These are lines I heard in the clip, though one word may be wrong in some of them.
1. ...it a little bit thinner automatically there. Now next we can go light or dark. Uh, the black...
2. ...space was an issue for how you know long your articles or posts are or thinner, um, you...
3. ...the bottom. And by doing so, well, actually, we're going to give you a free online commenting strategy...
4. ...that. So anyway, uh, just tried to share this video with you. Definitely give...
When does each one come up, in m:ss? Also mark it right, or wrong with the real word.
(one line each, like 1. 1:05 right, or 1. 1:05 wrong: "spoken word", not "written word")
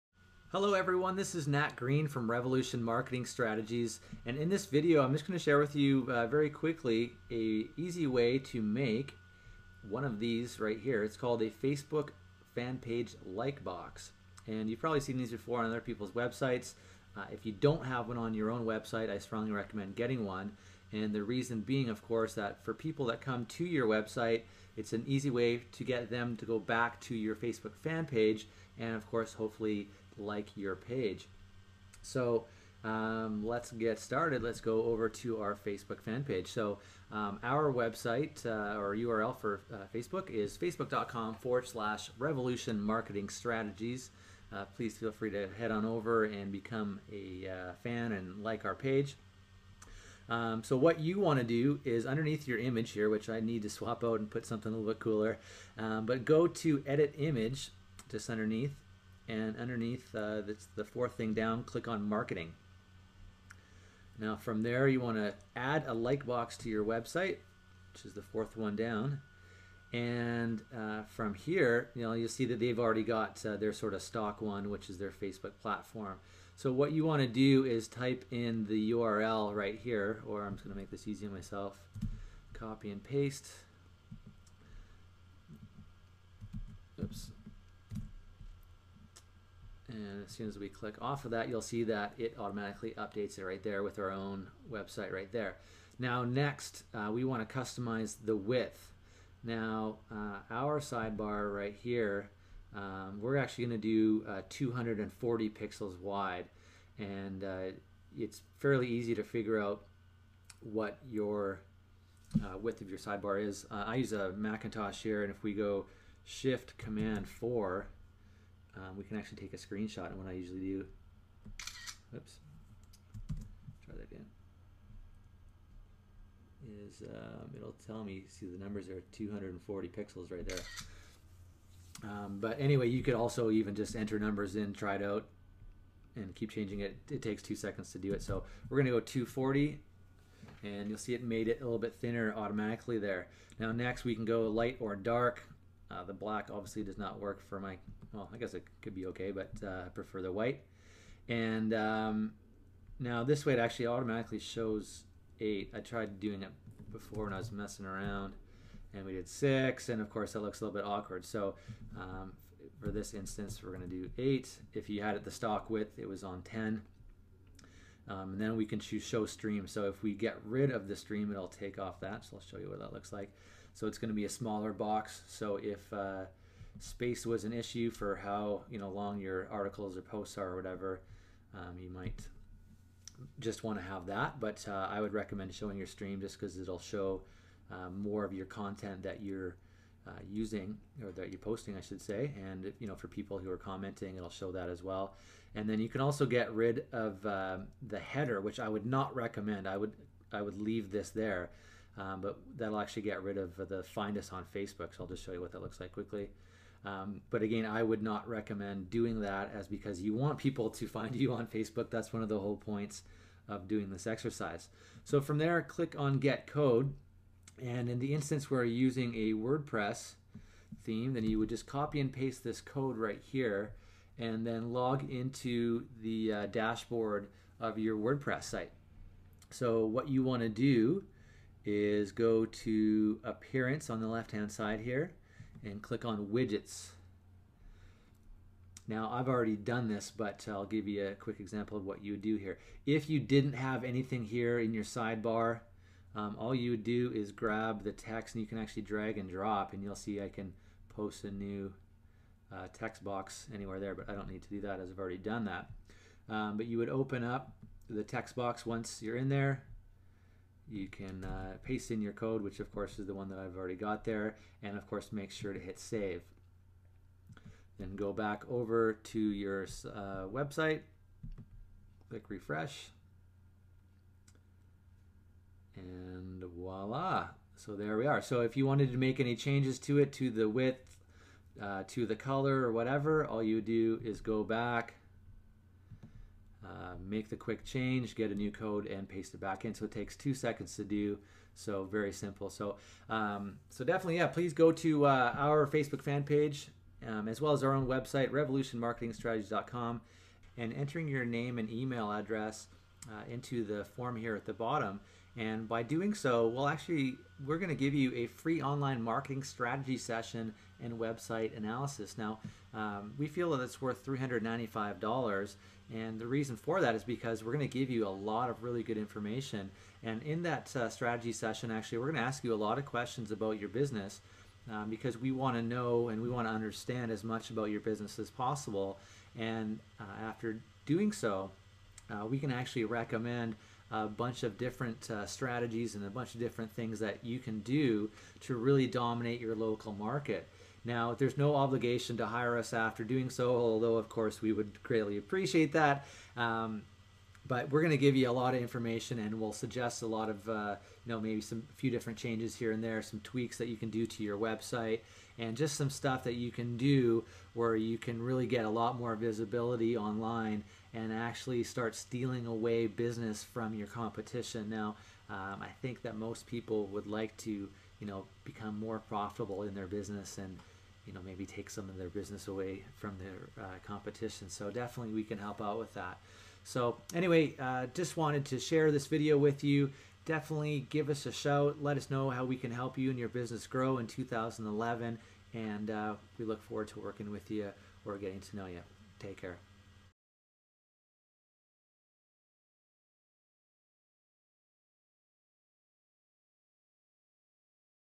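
1. 2:21 right
2. 2:56 wrong: "whatever", not "thinner"
3. 5:04 wrong: "marketing", not "commenting"
4. 6:15 wrong: "wanted", not "tried".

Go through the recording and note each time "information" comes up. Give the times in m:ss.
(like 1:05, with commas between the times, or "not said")
5:18, 5:48.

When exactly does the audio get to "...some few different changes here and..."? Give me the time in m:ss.
5:51.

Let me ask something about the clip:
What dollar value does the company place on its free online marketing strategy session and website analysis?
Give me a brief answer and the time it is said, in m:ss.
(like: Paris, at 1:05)
$395, at 5:14.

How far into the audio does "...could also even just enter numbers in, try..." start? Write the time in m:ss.
2:13.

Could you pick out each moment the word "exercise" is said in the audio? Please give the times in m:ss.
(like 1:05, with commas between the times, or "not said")
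3:34.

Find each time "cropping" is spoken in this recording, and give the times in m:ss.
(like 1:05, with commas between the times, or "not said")
not said.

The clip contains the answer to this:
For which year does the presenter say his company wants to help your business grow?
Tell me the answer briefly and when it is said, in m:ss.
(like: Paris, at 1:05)
2011, at 6:24.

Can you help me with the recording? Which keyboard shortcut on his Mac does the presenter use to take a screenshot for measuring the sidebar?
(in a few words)
Shift Command 4.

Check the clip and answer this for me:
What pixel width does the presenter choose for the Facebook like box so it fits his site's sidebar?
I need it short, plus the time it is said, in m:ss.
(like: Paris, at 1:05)
240, at 1:44.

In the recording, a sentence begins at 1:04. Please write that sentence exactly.
Now from there you want to add a like box to your website, which is the fourth one down.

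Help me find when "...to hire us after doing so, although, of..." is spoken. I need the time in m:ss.
5:42.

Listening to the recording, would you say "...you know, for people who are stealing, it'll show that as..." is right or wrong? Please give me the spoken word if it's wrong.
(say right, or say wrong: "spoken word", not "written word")
wrong: "commenting", not "stealing".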